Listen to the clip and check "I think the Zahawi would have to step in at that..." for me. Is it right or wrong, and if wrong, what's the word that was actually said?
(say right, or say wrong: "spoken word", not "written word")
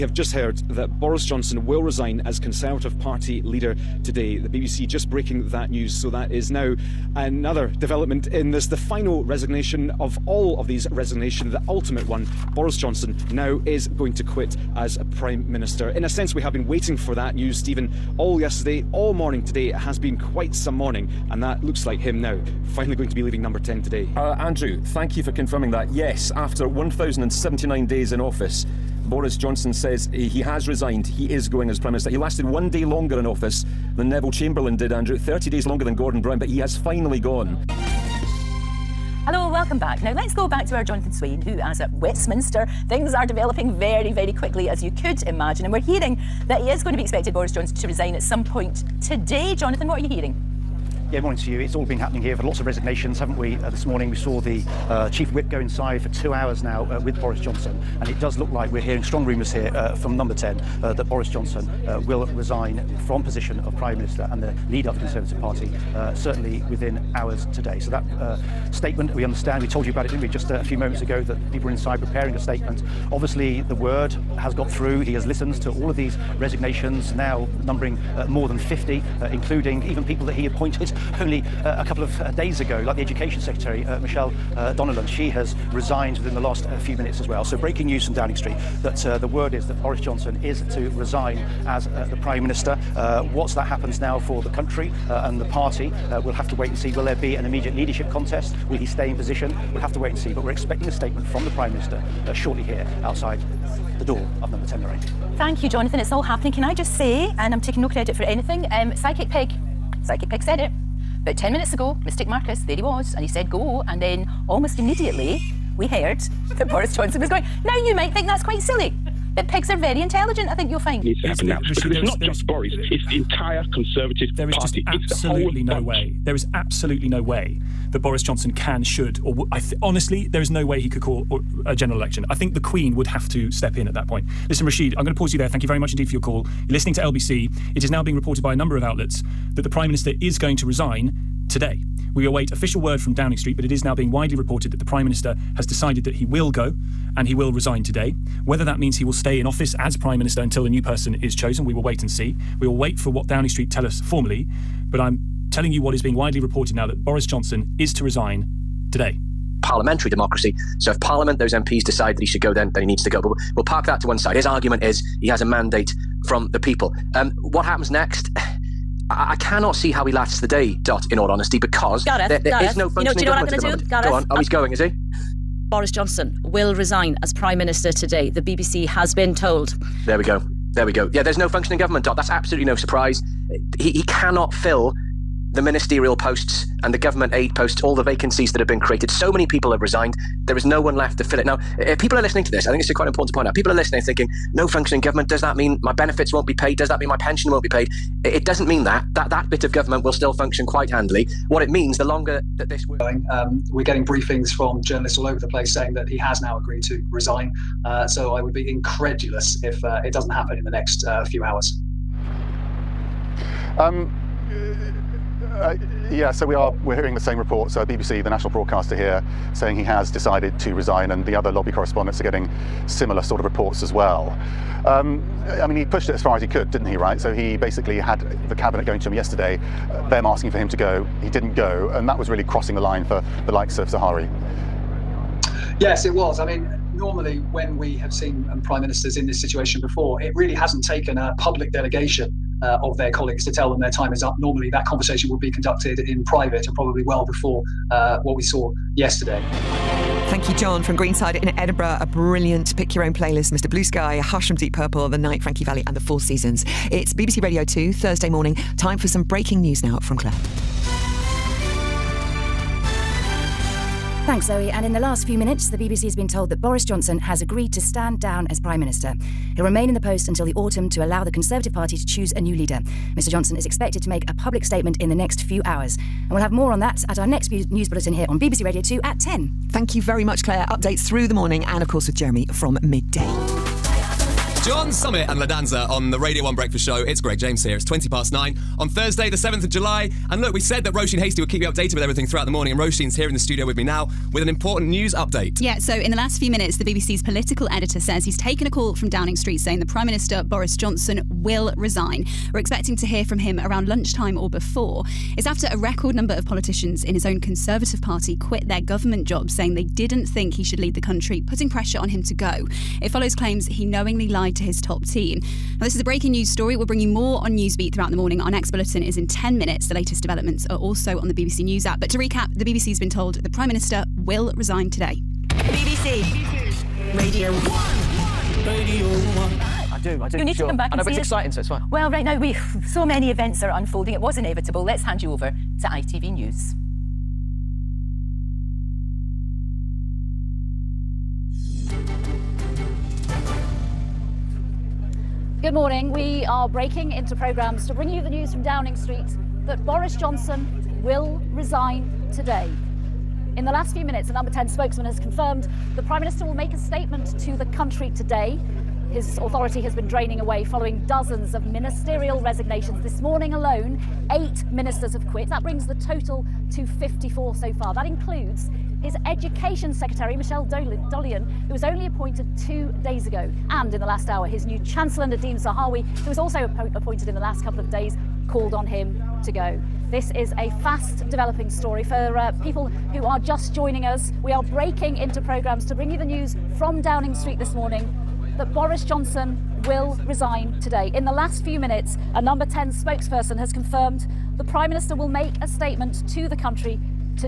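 wrong: "Queen", not "Zahawi".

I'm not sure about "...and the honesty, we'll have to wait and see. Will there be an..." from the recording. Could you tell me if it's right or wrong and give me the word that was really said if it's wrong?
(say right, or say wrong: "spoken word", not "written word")
wrong: "party", not "honesty".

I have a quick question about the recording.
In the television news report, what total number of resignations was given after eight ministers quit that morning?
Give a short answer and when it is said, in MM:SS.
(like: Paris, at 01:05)
54, at 06:06.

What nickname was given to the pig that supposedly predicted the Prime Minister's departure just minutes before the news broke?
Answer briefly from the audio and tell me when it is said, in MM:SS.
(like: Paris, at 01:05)
Mystic Marcus, at 01:52.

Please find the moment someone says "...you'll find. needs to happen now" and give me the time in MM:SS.
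02:00.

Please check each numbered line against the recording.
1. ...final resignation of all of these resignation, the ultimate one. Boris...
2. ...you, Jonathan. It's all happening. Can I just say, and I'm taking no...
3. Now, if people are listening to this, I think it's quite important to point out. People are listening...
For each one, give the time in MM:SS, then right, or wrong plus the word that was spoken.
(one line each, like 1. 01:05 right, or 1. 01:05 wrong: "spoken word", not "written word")
1. 00:08 right
2. 01:45 right
3. 03:11 right.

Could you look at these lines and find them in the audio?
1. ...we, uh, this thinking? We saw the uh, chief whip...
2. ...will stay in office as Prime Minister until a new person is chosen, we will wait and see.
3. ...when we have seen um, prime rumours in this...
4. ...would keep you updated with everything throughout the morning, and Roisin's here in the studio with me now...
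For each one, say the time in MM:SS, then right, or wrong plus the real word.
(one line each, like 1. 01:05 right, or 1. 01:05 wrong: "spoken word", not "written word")
1. 00:53 wrong: "morning", not "thinking"
2. 02:29 right
3. 03:57 wrong: "ministers", not "rumours"
4. 04:51 right.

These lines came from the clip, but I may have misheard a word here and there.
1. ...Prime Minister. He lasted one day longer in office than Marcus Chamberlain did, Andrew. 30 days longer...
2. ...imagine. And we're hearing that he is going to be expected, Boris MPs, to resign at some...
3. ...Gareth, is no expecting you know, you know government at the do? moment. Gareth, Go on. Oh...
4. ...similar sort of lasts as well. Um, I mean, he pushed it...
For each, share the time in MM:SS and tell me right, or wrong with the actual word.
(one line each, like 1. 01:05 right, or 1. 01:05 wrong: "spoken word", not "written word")
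1. 00:31 wrong: "Neville", not "Marcus"
2. 00:45 wrong: "Johnson", not "MPs"
3. 02:52 wrong: "functioning", not "expecting"
4. 03:42 wrong: "reports", not "lasts".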